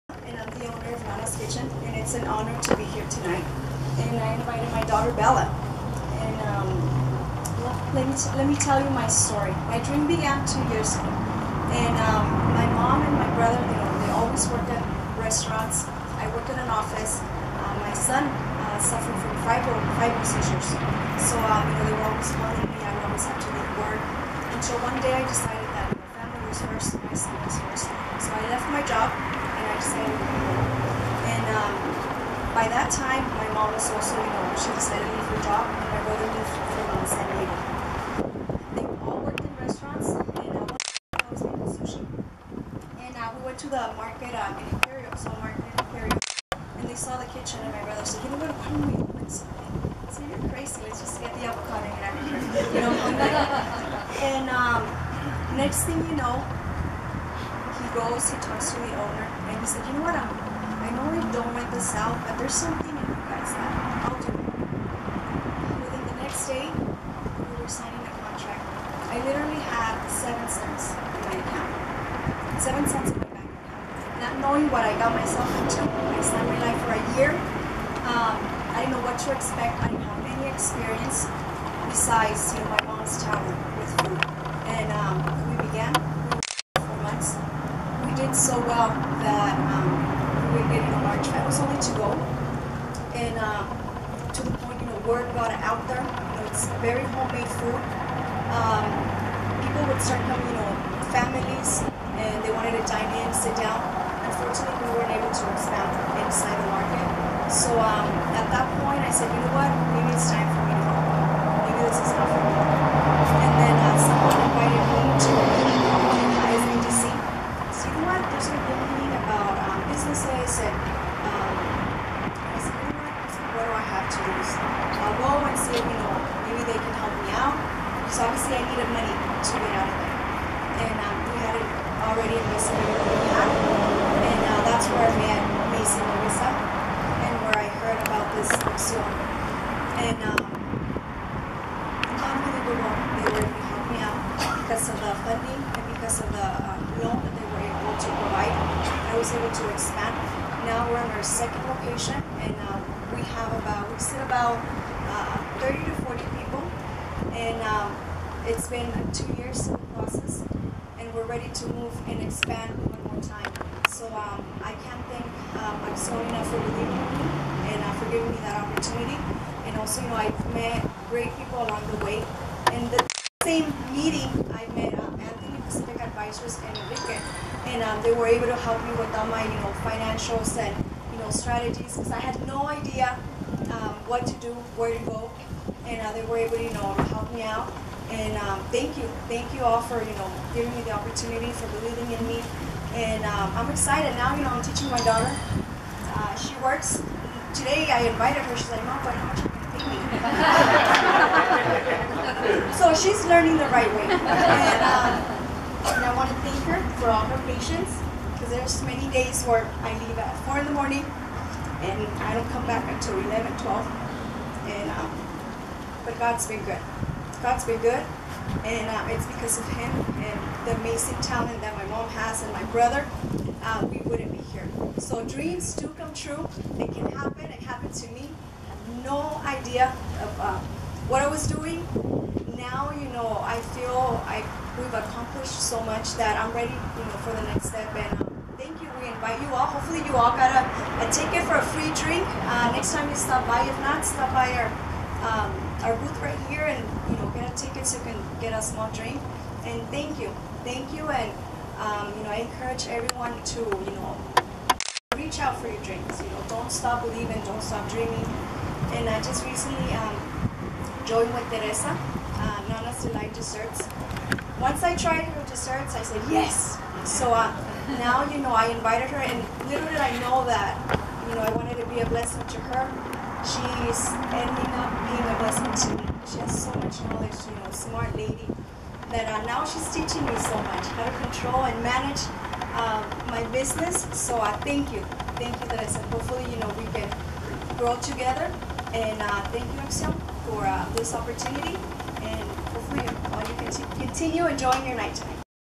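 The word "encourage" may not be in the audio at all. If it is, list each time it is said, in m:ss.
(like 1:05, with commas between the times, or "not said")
4:12.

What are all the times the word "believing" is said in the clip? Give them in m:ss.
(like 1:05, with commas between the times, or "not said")
2:46, 3:11, 4:17.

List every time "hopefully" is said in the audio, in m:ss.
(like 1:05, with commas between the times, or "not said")
3:59, 4:46.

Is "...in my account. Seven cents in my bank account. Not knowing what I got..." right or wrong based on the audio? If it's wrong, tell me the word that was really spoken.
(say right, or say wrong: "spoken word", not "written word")
right.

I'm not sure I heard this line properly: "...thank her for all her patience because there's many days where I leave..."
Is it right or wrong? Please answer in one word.
right.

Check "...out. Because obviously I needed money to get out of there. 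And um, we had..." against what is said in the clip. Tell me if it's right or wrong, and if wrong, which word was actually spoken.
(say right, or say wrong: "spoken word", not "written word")
right.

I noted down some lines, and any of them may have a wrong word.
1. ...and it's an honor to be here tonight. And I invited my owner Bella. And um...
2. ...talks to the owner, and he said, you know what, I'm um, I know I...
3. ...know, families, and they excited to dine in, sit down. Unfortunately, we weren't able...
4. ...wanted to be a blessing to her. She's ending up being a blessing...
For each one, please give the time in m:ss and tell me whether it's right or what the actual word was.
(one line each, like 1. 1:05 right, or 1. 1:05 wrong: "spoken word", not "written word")
1. 0:01 wrong: "daughter", not "owner"
2. 0:58 right
3. 1:40 wrong: "wanted", not "excited"
4. 4:31 right.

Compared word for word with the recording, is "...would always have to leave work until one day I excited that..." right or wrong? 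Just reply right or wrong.
wrong.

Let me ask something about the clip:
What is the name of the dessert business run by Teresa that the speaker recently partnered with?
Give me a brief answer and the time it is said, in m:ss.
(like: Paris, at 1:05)
Nana's Delight Desserts, at 4:22.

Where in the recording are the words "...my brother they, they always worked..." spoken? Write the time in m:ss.
0:13.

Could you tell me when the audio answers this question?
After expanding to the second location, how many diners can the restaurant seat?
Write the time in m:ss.
2:35.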